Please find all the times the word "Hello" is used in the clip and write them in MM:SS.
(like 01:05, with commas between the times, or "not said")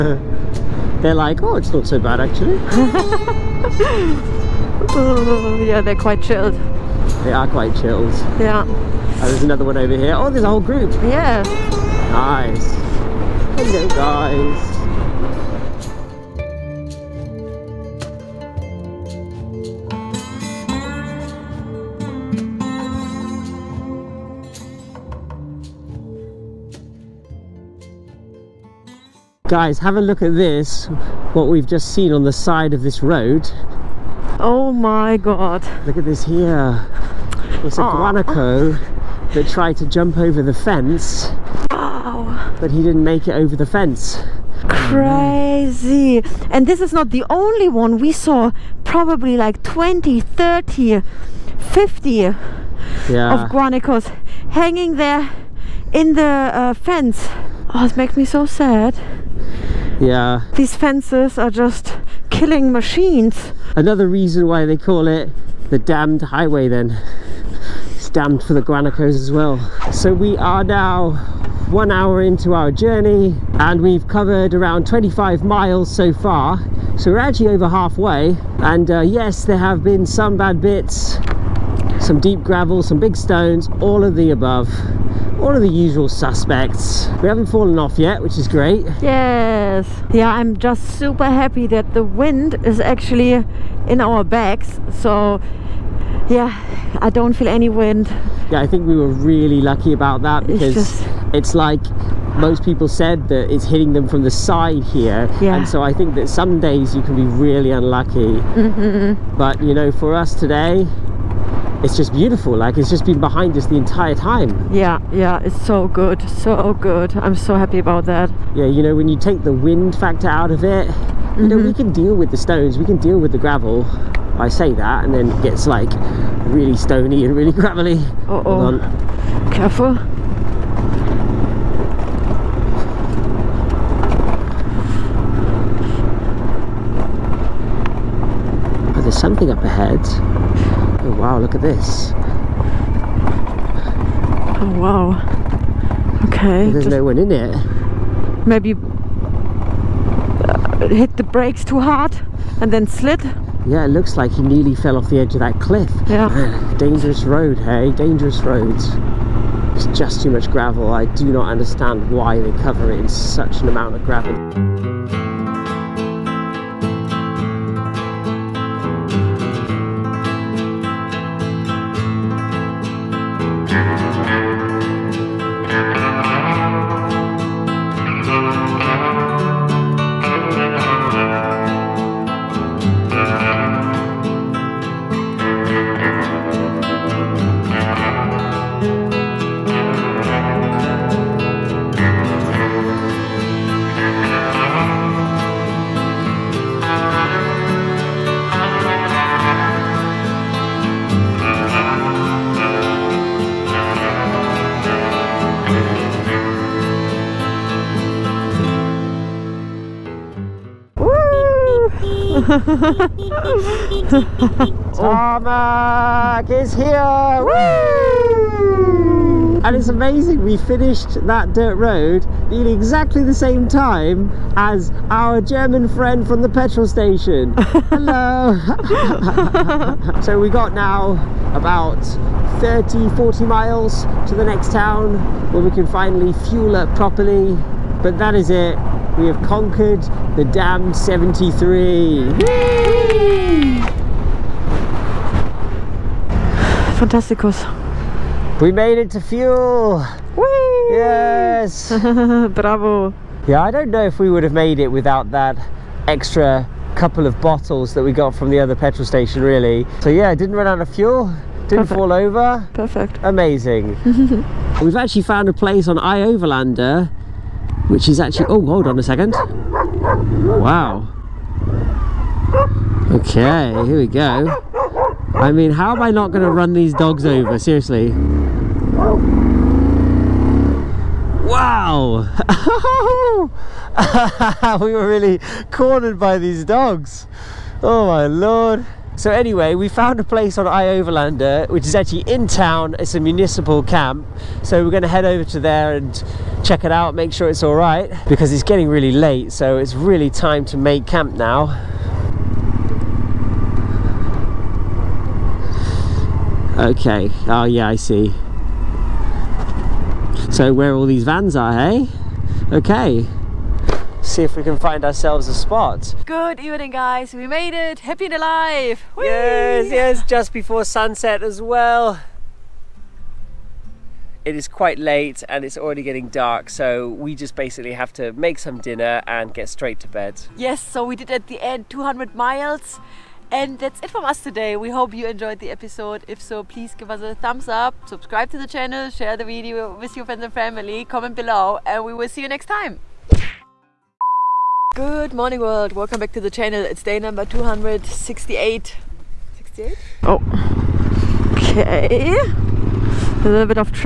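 00:13, 03:47.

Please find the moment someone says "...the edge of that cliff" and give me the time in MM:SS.
02:35.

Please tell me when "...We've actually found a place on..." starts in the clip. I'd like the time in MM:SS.
04:24.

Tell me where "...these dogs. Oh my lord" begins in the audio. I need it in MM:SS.
04:46.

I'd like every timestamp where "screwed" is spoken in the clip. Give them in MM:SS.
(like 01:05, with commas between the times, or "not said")
not said.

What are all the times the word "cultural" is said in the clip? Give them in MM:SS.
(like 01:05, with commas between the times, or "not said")
not said.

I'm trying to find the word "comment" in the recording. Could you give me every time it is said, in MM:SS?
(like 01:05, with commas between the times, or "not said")
05:41.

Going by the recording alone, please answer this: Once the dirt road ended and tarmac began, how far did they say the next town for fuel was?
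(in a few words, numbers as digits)
30 to 40 miles.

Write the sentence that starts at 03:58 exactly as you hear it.
But that is it we have conquered the damned 73.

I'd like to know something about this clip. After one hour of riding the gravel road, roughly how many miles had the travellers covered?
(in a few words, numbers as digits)
25 miles.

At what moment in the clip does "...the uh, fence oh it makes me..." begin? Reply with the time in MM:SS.
00:56.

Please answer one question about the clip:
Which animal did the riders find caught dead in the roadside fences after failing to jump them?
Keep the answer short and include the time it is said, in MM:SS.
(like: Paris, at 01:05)
guanaco, at 00:37.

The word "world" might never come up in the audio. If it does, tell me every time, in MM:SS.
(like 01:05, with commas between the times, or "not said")
05:45.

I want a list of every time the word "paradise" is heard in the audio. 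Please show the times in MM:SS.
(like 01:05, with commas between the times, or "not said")
not said.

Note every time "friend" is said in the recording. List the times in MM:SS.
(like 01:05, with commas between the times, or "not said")
03:45, 05:40.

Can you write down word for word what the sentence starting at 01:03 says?
Another reason why they call it the damned highway then.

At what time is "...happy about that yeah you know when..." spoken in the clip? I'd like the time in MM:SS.
01:57.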